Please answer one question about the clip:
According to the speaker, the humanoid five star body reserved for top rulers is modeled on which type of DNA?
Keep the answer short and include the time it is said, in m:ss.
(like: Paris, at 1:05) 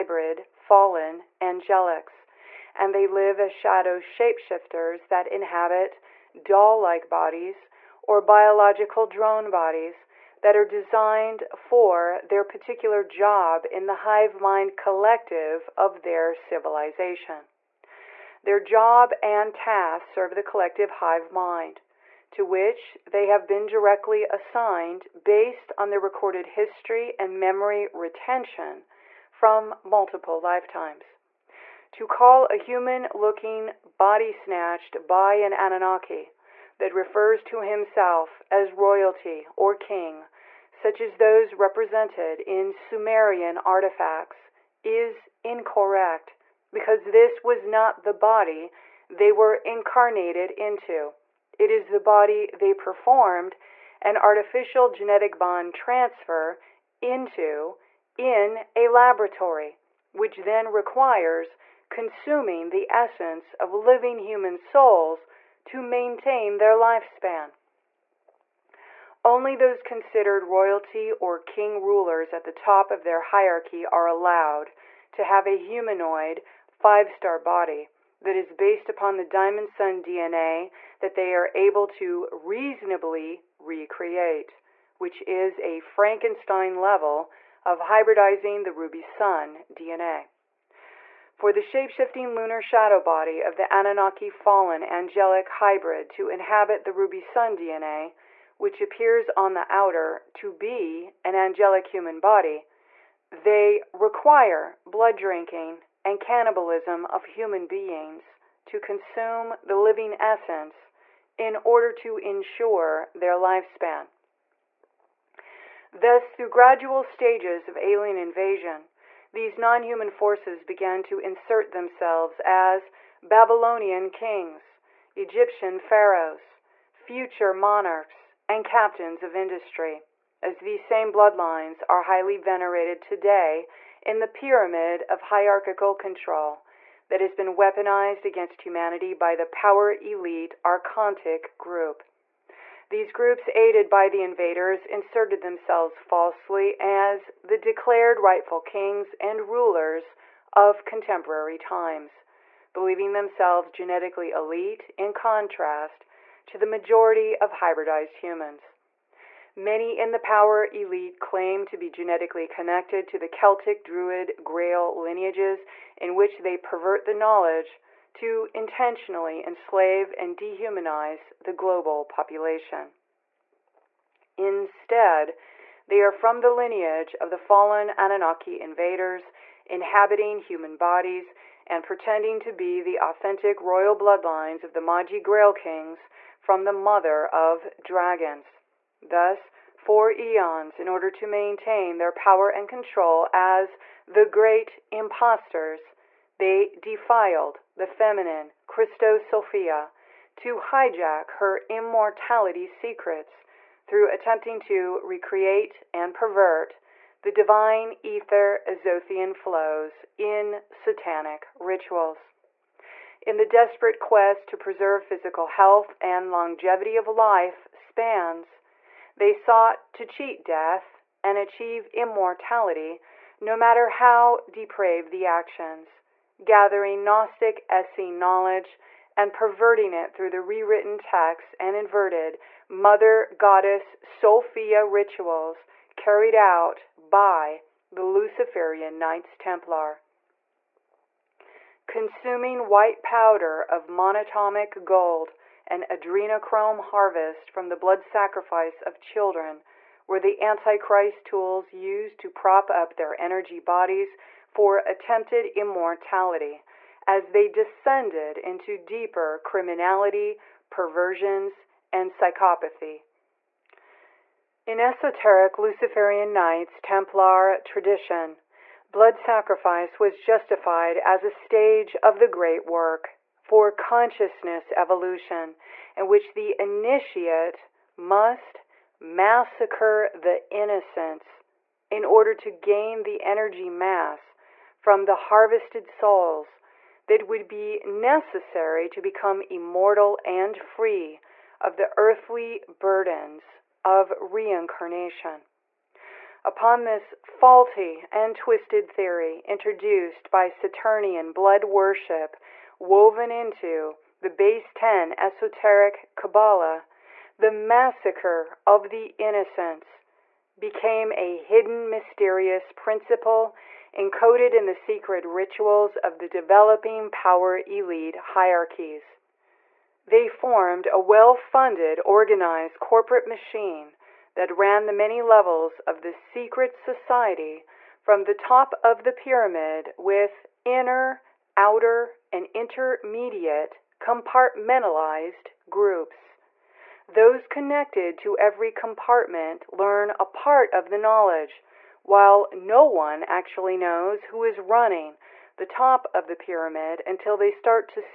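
Diamond Sun DNA, at 1:19.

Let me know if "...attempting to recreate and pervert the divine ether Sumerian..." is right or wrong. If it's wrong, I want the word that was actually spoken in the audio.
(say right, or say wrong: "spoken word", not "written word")
wrong: "Azothian", not "Sumerian".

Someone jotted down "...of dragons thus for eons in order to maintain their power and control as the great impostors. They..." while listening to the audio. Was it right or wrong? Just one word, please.
right.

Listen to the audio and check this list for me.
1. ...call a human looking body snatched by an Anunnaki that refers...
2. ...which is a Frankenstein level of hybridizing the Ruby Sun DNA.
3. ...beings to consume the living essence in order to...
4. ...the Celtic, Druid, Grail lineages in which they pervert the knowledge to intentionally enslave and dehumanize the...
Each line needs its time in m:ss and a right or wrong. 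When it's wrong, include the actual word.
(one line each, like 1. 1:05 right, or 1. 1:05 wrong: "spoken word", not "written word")
1. 0:32 right
2. 1:24 right
3. 1:47 right
4. 2:43 right.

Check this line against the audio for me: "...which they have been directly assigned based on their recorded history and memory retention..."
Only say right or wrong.
right.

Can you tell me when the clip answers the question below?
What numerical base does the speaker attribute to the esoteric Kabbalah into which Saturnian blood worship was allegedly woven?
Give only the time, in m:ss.
5:04.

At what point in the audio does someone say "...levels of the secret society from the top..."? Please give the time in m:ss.
5:25.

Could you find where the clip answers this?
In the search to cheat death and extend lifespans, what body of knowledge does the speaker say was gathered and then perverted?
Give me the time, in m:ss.
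3:47.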